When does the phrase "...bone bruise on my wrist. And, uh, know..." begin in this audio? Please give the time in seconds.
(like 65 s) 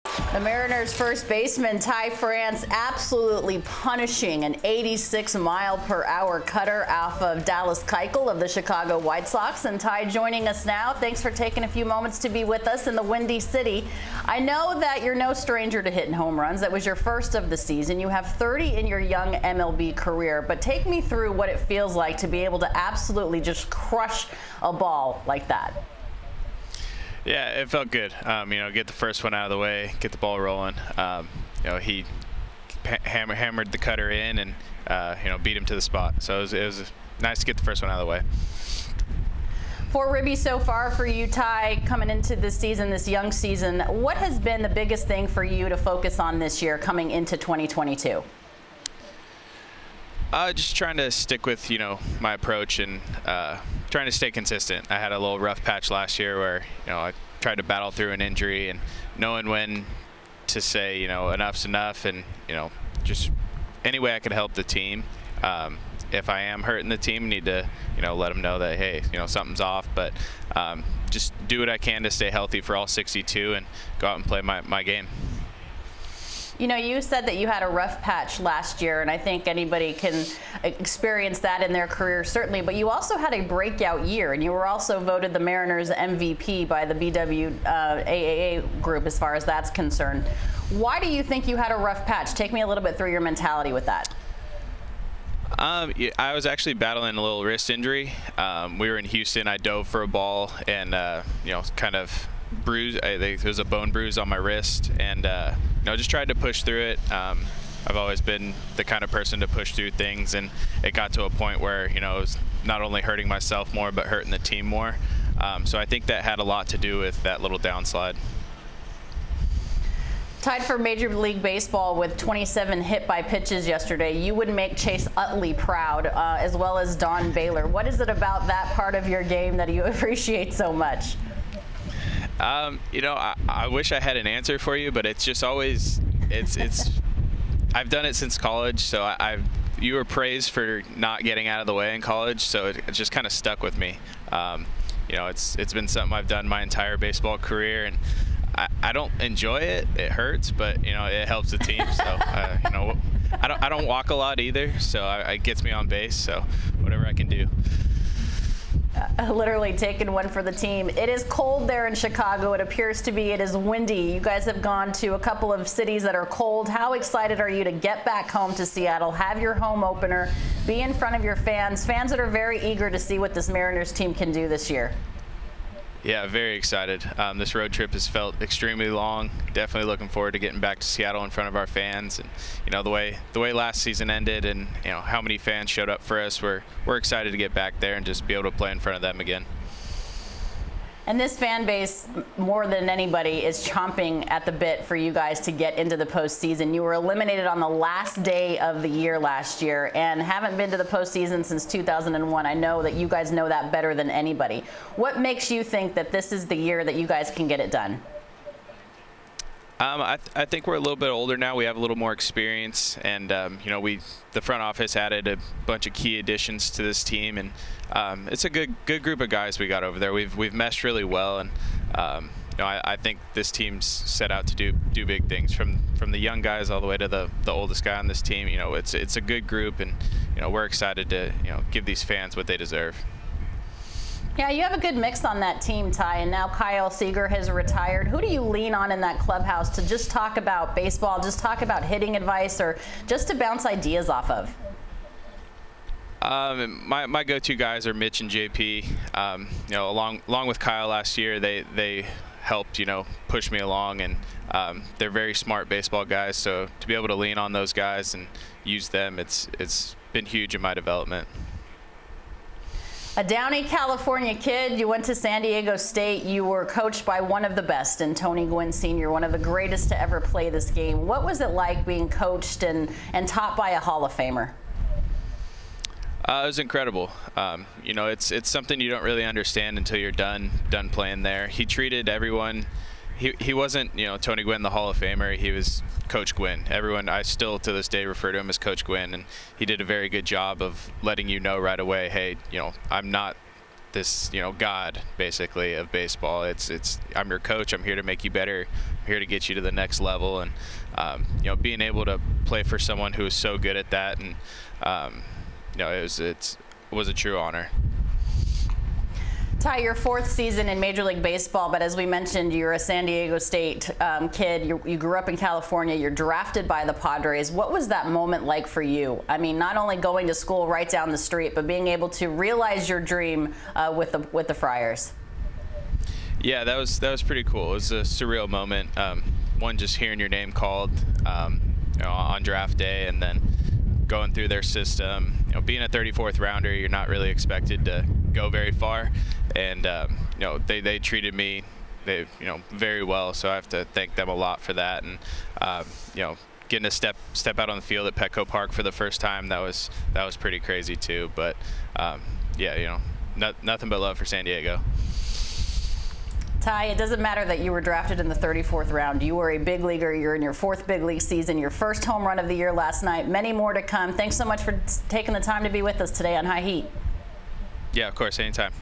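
103 s.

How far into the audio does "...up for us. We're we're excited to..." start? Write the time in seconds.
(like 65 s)
185 s.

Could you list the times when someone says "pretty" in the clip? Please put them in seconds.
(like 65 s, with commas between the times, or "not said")
327 s, 350 s.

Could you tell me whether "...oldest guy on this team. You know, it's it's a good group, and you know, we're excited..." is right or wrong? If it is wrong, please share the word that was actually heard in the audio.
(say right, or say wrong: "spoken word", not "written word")
right.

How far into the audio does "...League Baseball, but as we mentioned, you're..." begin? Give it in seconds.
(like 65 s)
311 s.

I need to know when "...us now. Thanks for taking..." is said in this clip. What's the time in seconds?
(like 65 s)
10 s.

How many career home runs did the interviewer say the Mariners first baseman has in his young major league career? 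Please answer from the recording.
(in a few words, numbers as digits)
30.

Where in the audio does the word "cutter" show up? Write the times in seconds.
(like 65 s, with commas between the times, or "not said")
6 s, 33 s.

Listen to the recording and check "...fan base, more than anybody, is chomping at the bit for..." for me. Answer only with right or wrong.
right.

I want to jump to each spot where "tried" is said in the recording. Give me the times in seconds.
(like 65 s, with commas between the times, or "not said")
57 s, 106 s.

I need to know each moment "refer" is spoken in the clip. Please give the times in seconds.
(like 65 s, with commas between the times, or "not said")
288 s.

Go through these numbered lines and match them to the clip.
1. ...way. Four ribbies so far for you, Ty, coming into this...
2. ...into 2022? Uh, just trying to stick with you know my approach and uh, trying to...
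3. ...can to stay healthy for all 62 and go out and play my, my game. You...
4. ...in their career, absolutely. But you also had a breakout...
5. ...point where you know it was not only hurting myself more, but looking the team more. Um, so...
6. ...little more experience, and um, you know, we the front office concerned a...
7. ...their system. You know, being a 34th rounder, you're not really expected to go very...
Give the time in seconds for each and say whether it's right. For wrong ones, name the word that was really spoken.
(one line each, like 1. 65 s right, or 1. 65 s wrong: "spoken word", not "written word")
1. 38 s right
2. 47 s right
3. 71 s right
4. 81 s wrong: "certainly", not "absolutely"
5. 111 s wrong: "hurting", not "looking"
6. 211 s wrong: "added", not "concerned"
7. 334 s right.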